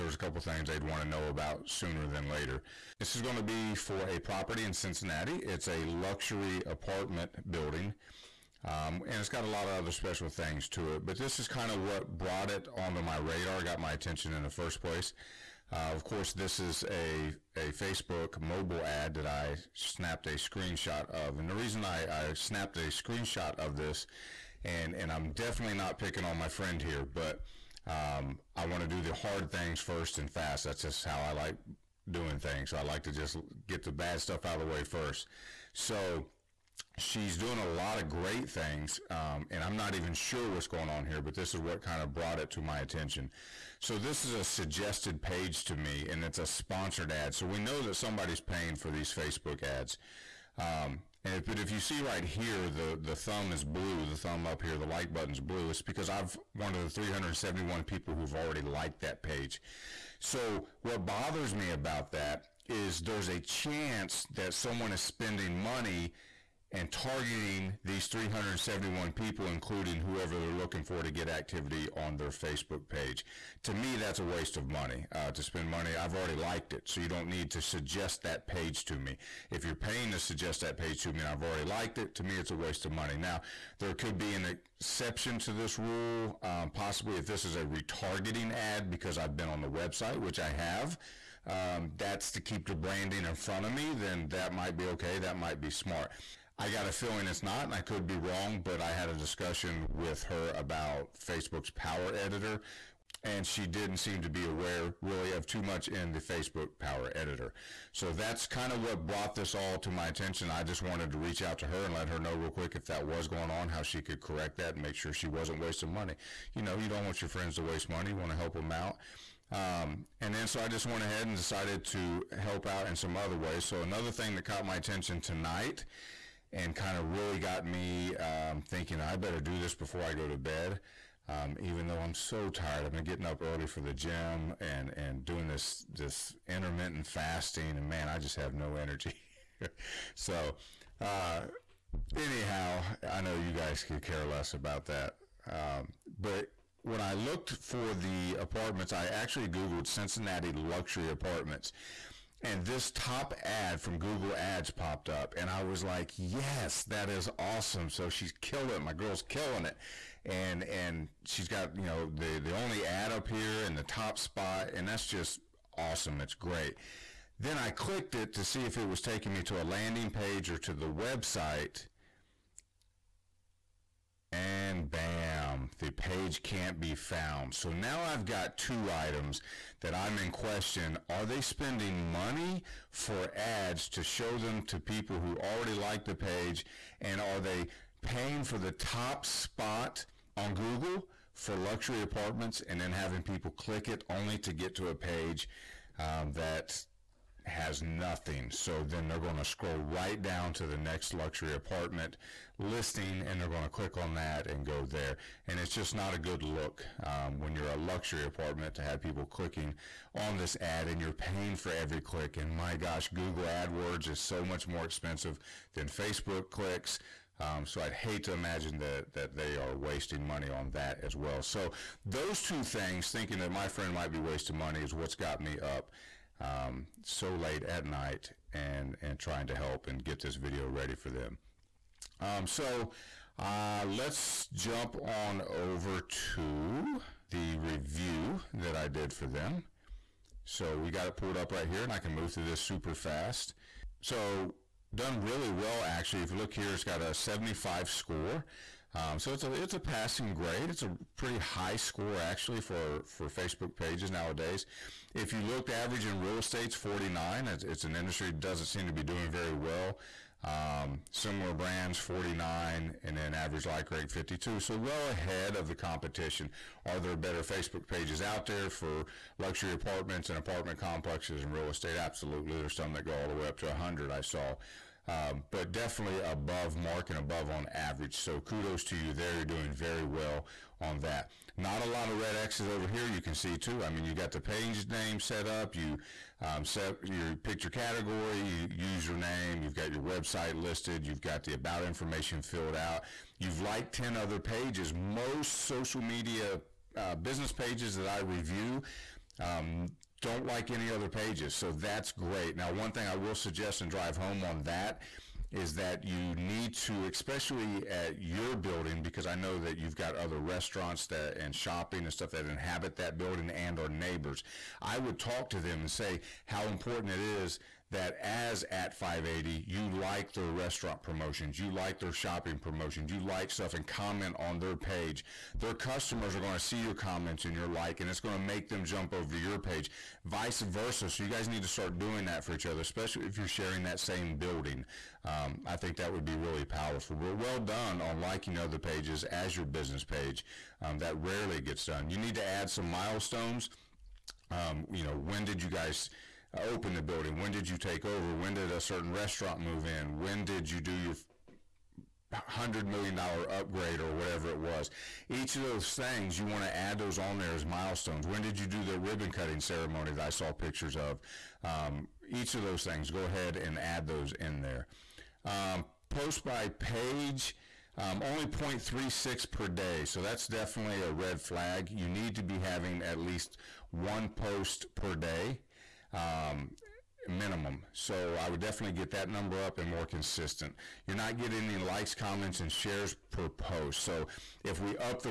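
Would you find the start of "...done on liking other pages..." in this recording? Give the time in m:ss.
5:37.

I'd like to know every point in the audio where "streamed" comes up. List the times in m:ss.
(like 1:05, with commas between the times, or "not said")
not said.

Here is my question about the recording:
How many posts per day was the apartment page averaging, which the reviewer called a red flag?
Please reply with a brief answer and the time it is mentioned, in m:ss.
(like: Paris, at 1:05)
0.36, at 6:08.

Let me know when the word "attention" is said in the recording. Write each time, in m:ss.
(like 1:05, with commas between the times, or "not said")
0:13, 0:42, 1:50, 2:04.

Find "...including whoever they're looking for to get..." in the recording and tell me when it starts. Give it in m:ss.
1:09.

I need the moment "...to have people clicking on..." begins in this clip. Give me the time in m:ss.
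3:28.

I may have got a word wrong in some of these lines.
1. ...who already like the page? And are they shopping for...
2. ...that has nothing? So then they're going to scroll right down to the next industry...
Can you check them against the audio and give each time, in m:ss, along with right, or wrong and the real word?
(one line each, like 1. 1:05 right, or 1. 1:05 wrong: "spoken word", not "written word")
1. 3:05 wrong: "paying", not "shopping"
2. 3:16 wrong: "luxury", not "industry".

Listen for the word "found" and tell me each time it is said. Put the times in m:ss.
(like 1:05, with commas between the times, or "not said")
2:56.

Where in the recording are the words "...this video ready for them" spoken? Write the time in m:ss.
3:50.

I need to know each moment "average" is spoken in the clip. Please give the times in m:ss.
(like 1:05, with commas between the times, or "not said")
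4:15, 4:23, 4:37.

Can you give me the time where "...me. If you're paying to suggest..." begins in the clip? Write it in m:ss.
1:18.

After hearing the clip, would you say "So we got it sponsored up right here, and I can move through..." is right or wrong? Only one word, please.
wrong.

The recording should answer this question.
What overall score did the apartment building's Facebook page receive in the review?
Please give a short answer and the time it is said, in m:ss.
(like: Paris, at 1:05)
75, at 4:07.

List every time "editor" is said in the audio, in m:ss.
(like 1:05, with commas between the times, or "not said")
1:42, 1:47.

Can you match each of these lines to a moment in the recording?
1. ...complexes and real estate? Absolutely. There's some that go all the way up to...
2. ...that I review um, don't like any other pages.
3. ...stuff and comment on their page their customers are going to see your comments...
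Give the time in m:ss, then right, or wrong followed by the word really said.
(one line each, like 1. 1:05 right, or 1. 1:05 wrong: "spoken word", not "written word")
1. 4:30 right
2. 4:57 right
3. 5:23 right.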